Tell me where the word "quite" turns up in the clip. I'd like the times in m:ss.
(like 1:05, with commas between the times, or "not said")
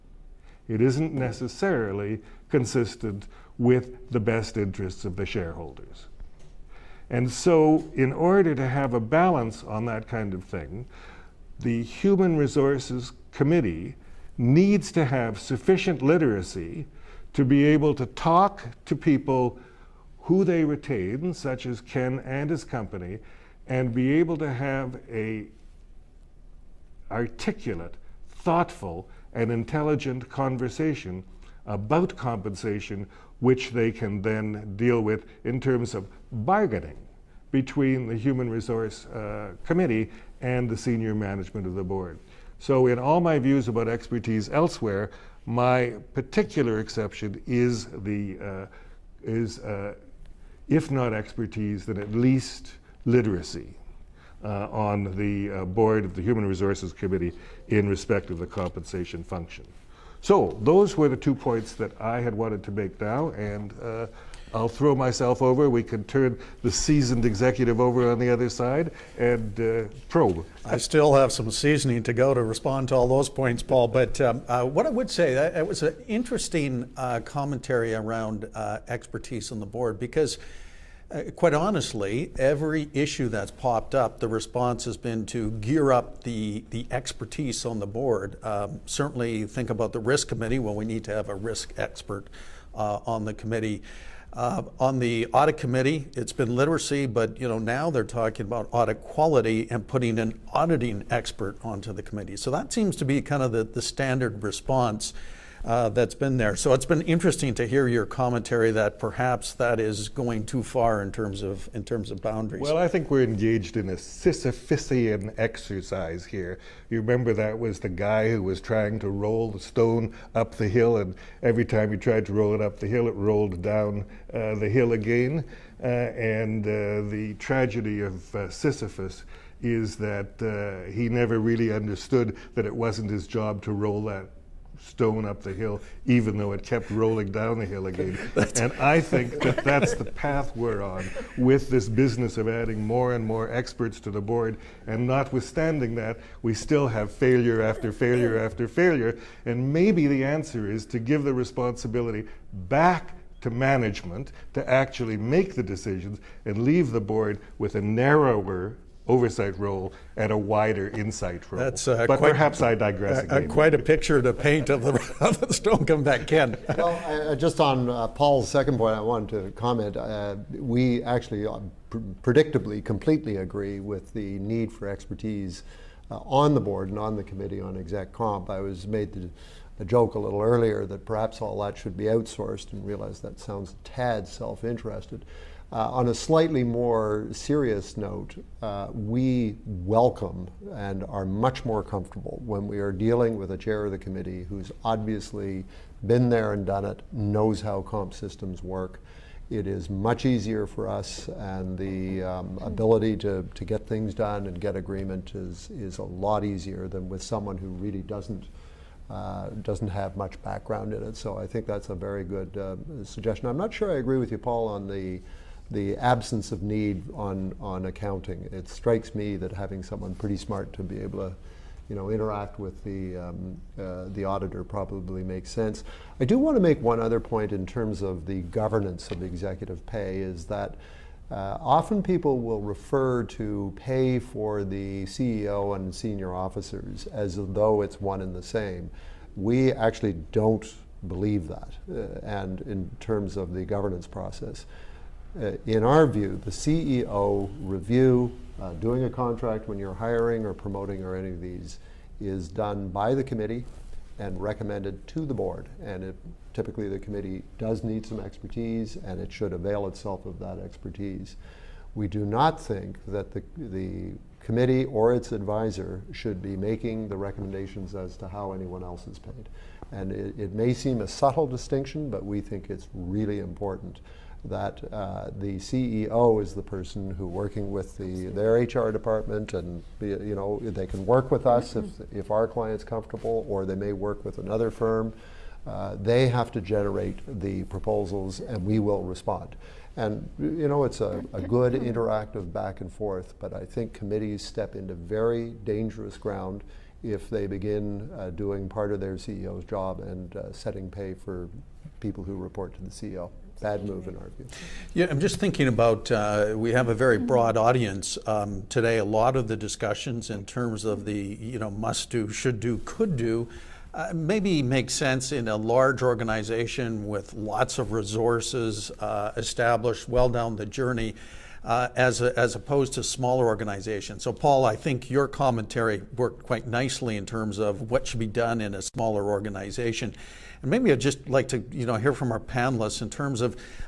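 1:21, 2:43, 5:26.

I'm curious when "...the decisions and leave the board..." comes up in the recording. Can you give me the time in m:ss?
2:35.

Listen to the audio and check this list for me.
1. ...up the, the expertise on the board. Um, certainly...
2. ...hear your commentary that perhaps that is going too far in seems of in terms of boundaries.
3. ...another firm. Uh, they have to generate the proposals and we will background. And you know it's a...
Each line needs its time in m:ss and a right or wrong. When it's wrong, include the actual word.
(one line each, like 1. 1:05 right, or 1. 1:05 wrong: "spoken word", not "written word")
1. 1:25 right
2. 1:47 wrong: "terms", not "seems"
3. 4:44 wrong: "respond", not "background".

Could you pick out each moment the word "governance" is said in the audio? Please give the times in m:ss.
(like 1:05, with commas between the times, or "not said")
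3:48, 4:03.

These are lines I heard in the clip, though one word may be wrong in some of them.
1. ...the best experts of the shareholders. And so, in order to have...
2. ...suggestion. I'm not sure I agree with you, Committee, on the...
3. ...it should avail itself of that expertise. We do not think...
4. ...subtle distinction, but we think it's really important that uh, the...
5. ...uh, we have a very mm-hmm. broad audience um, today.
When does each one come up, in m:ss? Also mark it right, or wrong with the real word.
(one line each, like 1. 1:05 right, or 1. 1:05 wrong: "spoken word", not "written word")
1. 0:04 wrong: "interests", not "experts"
2. 3:33 wrong: "Paul", not "Committee"
3. 4:19 right
4. 4:31 right
5. 5:06 right.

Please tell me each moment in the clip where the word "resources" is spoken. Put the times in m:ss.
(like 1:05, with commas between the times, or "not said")
0:12, 0:38, 0:56, 5:17.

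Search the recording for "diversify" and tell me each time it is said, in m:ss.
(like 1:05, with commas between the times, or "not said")
not said.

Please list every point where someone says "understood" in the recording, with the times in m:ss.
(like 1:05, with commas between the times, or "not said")
2:11.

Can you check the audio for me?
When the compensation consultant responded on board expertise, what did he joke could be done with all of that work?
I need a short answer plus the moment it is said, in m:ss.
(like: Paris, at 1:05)
outsourced, at 3:02.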